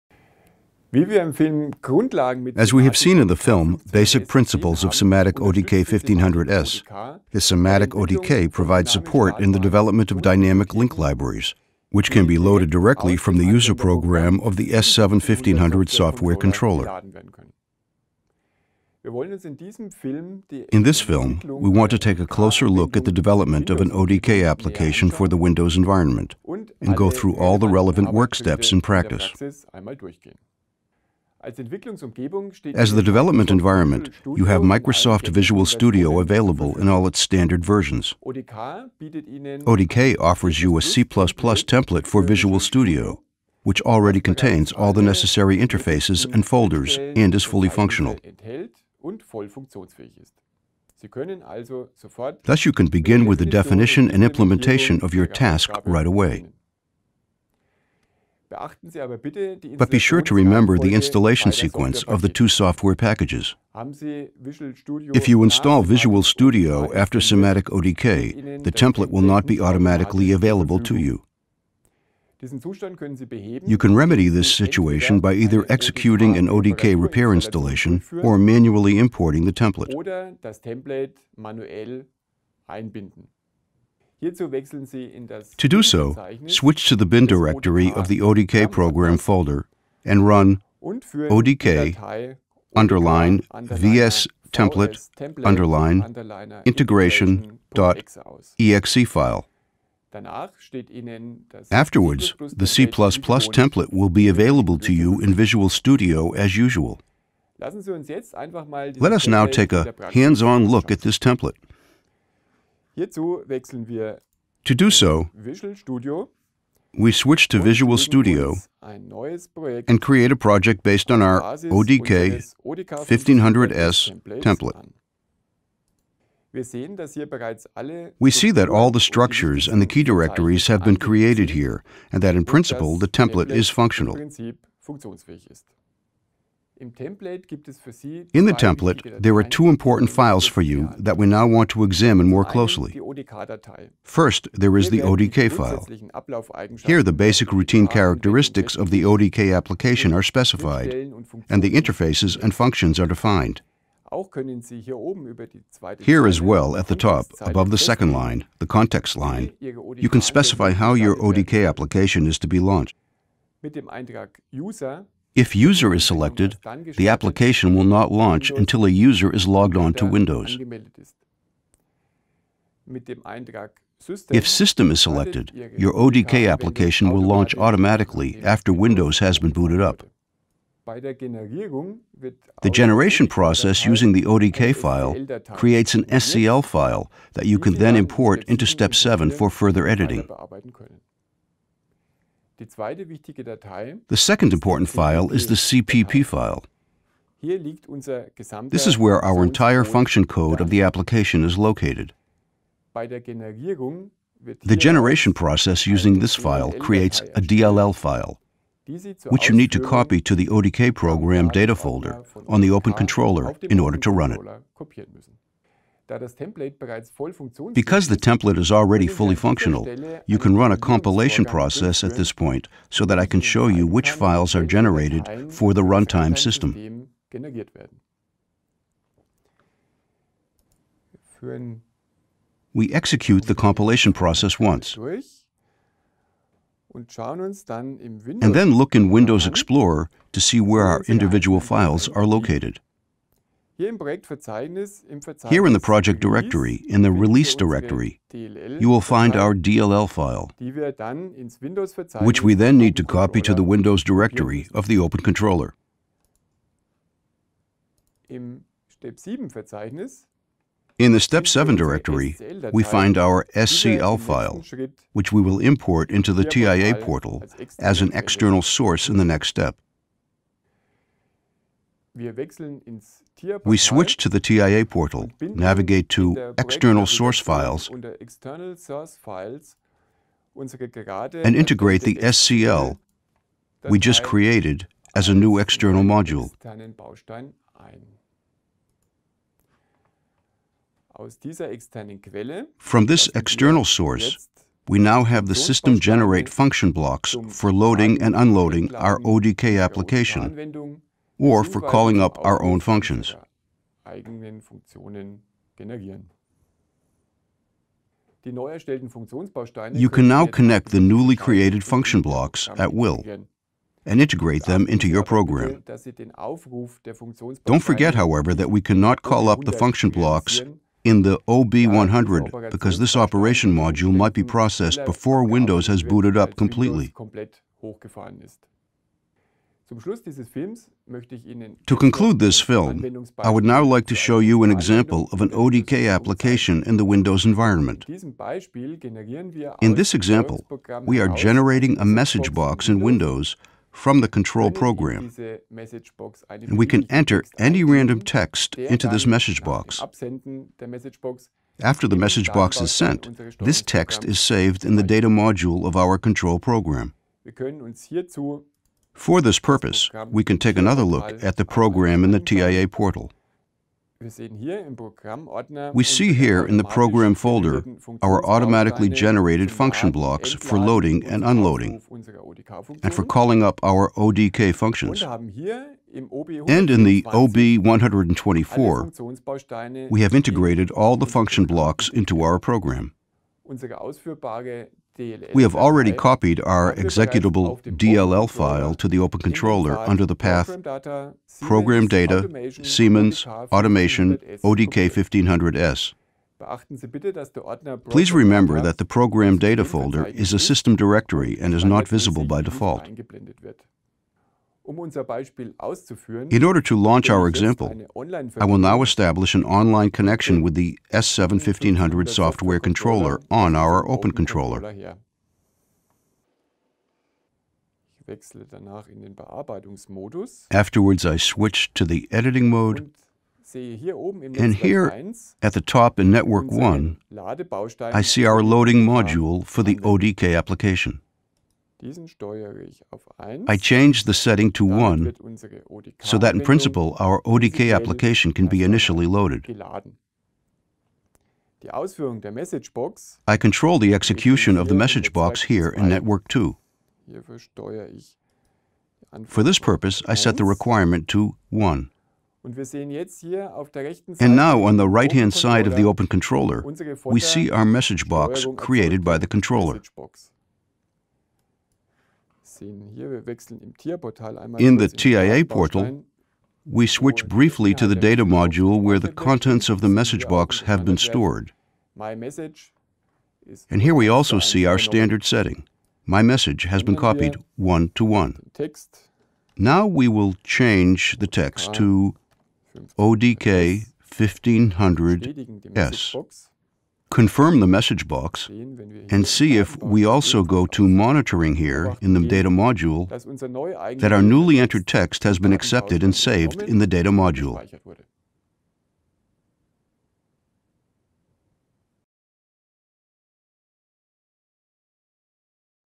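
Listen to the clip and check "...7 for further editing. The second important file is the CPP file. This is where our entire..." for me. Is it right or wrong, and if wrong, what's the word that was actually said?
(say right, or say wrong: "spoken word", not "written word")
right.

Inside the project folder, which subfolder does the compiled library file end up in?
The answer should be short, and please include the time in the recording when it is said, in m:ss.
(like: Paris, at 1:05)
release directory, at 4:07.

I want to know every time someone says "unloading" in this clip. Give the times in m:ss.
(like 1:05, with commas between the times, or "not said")
4:58, 6:11.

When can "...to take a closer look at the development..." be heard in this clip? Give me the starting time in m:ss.
0:21.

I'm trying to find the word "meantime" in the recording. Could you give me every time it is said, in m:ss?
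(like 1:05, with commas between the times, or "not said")
not said.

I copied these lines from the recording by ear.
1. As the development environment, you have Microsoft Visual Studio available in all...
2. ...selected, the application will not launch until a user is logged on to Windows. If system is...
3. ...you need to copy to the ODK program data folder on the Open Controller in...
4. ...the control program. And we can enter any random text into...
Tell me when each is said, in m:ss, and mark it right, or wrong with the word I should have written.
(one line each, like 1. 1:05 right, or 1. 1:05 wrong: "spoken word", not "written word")
1. 0:31 right
2. 2:46 right
3. 3:29 right
4. 5:44 right.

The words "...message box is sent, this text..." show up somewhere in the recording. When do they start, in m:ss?
5:52.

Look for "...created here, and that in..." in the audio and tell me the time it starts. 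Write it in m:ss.
2:10.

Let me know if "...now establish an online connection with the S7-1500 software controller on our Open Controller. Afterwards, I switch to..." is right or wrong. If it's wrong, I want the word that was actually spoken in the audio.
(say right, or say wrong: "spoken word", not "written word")
right.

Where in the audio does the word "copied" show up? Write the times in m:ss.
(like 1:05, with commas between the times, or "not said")
6:26, 7:57.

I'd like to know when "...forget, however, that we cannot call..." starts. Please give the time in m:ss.
5:17.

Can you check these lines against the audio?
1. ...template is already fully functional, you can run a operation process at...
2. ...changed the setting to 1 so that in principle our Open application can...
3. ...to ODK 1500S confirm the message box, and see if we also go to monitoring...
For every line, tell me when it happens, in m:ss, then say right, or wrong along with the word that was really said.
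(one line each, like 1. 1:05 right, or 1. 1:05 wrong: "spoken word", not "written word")
1. 3:38 wrong: "compilation", not "operation"
2. 7:13 wrong: "ODK", not "Open"
3. 8:01 right.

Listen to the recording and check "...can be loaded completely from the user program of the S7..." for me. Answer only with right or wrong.
wrong.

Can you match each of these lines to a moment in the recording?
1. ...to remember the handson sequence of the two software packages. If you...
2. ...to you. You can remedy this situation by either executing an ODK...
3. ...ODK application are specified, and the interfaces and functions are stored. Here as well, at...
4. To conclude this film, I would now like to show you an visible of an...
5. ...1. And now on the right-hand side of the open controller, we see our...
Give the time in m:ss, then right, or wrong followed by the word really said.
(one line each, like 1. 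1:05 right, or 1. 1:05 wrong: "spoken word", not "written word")
1. 1:00 wrong: "installation", not "handson"
2. 1:10 right
3. 2:29 wrong: "defined", not "stored"
4. 5:31 wrong: "example", not "visible"
5. 7:31 right.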